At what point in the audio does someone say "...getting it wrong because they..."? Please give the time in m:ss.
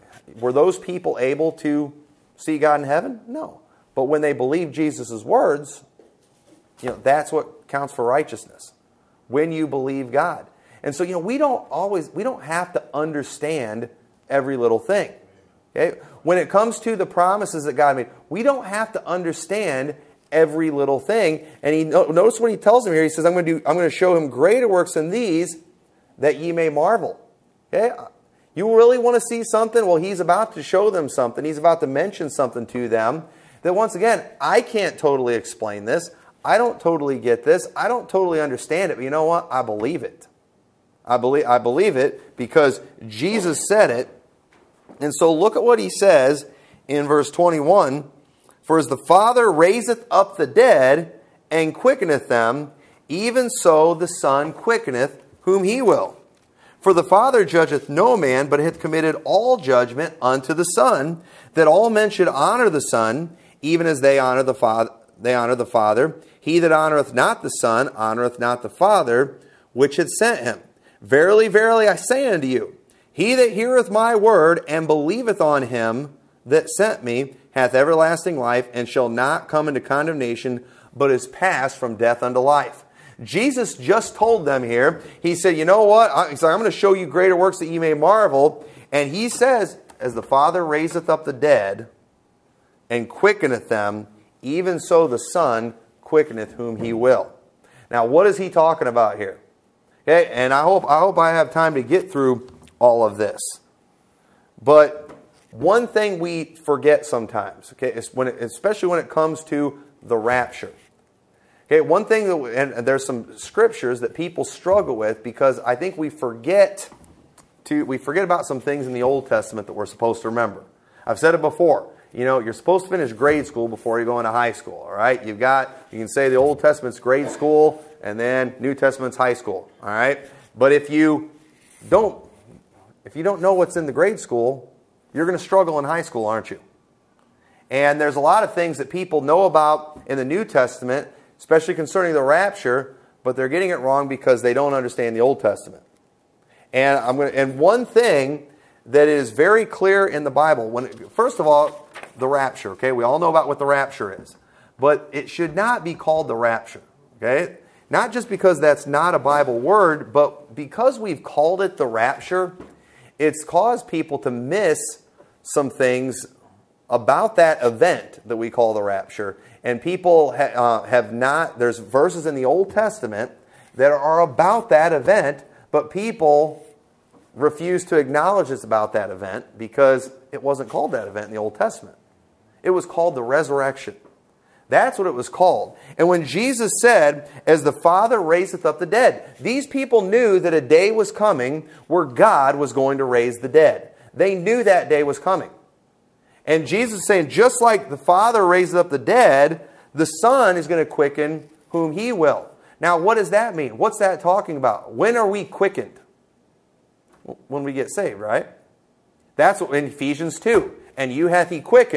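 2:23.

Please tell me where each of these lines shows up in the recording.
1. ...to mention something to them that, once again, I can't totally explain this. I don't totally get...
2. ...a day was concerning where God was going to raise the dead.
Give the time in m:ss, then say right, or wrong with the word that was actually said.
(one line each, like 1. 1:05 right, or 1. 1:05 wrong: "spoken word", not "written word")
1. 0:31 right
2. 3:10 wrong: "coming", not "concerning".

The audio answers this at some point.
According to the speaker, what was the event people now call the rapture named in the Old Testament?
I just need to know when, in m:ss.
3:03.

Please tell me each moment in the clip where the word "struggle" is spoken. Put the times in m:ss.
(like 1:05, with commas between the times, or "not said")
1:54, 2:15.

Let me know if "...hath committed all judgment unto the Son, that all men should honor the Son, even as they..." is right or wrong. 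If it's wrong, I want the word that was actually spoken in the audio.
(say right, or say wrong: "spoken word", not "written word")
right.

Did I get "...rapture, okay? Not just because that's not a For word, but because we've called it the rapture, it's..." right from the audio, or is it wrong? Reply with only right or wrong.
wrong.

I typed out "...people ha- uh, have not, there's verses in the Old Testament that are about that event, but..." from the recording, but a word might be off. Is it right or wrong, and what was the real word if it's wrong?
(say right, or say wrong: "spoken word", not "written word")
right.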